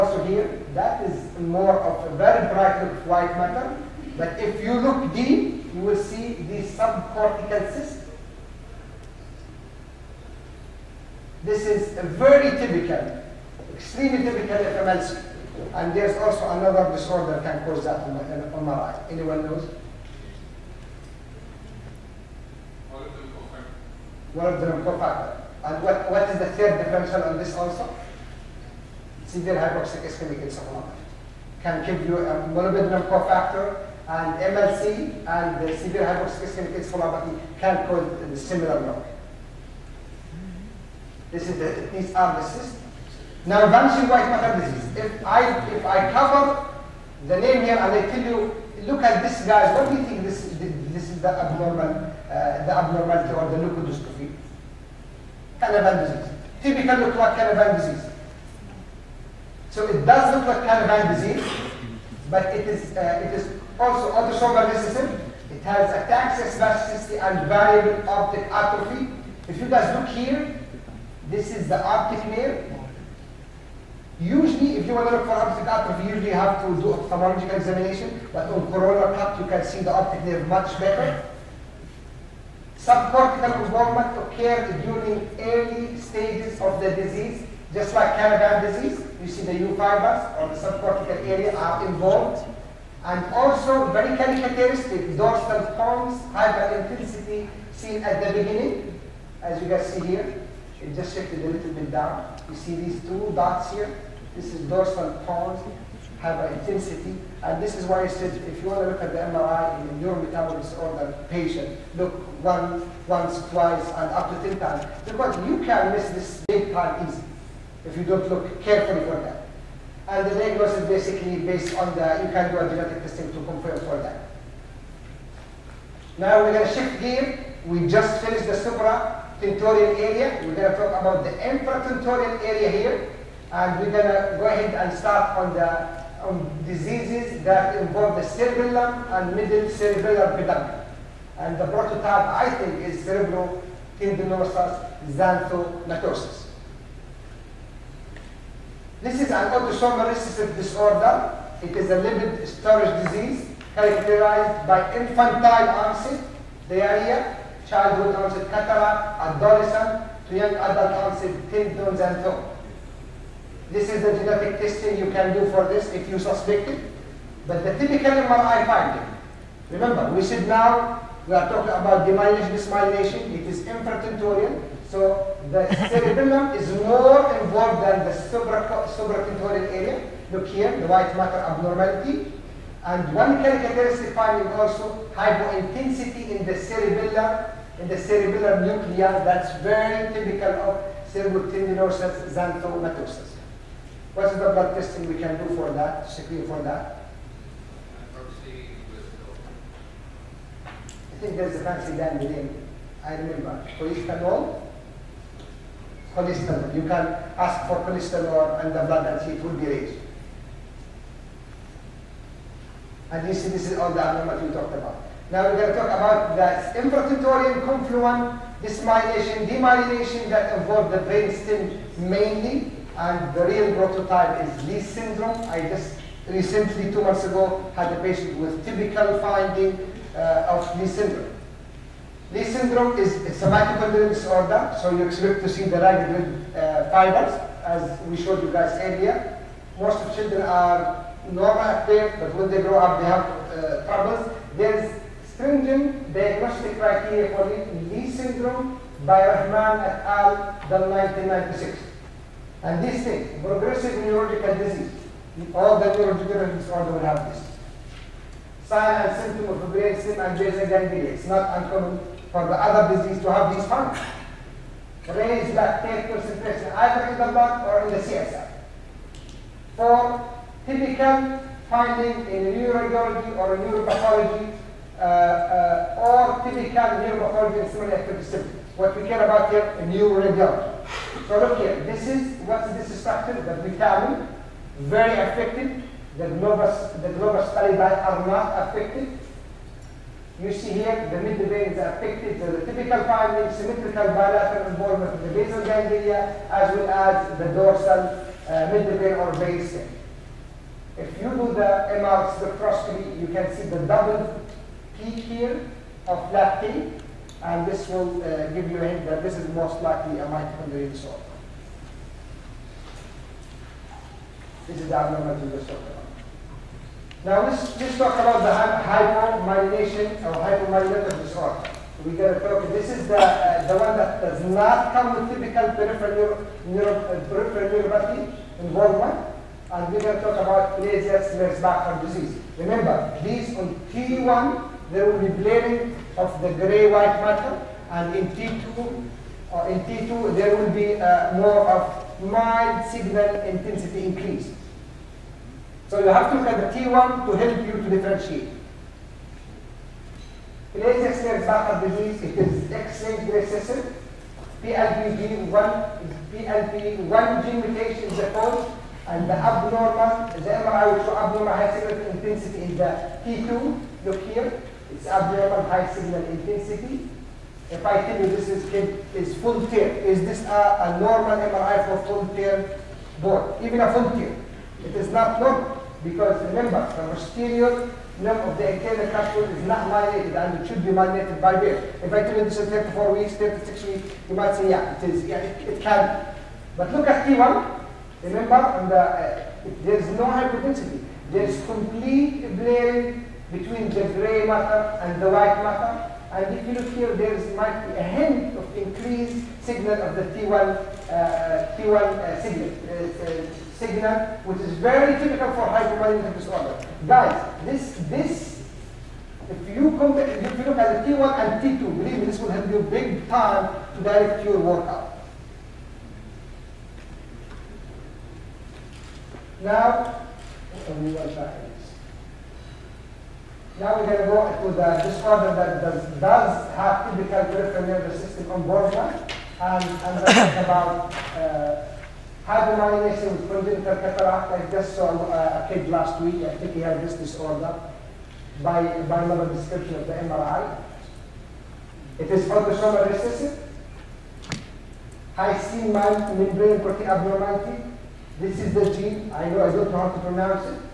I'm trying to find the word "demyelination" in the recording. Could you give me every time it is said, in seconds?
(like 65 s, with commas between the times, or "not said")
172 s, 219 s.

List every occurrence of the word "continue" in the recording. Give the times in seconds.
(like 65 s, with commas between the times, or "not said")
not said.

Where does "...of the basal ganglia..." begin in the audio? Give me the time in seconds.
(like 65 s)
295 s.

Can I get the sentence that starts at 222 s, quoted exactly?
And the real prototype is Leigh syndrome.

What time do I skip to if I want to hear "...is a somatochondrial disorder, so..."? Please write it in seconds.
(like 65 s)
232 s.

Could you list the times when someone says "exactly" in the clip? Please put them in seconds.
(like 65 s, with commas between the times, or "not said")
not said.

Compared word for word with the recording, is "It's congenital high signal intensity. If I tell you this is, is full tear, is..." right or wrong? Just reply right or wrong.
wrong.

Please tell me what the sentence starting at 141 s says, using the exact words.
And the prototype, I think, is cerebrotendinous xanthomatosis.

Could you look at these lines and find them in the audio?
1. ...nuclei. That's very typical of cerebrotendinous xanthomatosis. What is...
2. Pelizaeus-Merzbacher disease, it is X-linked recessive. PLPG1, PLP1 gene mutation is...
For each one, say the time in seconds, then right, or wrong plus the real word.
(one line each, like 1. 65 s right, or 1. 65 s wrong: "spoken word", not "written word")
1. 188 s right
2. 350 s right.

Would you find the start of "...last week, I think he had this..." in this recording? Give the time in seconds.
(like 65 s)
435 s.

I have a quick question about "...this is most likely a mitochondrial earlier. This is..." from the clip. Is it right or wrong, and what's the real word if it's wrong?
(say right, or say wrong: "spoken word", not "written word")
wrong: "disorder", not "earlier".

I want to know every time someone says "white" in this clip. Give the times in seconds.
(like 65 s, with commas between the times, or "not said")
3 s, 44 s, 180 s, 336 s, 395 s.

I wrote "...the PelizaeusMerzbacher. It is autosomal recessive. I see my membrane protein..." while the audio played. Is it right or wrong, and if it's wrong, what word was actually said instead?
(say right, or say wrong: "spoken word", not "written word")
wrong: "MRI", not "PelizaeusMerzbacher".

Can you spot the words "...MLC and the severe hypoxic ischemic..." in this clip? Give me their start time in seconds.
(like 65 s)
34 s.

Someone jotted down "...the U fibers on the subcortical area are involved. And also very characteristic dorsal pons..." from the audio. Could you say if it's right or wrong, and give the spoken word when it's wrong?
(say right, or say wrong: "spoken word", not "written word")
right.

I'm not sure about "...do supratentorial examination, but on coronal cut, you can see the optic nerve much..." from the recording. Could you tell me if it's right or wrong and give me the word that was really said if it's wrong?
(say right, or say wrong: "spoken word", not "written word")
wrong: "ophthalmological", not "supratentorial".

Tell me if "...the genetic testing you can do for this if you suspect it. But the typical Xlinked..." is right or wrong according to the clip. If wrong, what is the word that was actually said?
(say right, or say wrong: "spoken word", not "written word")
wrong: "MRI", not "Xlinked".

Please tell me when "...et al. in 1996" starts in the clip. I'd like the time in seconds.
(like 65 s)
249 s.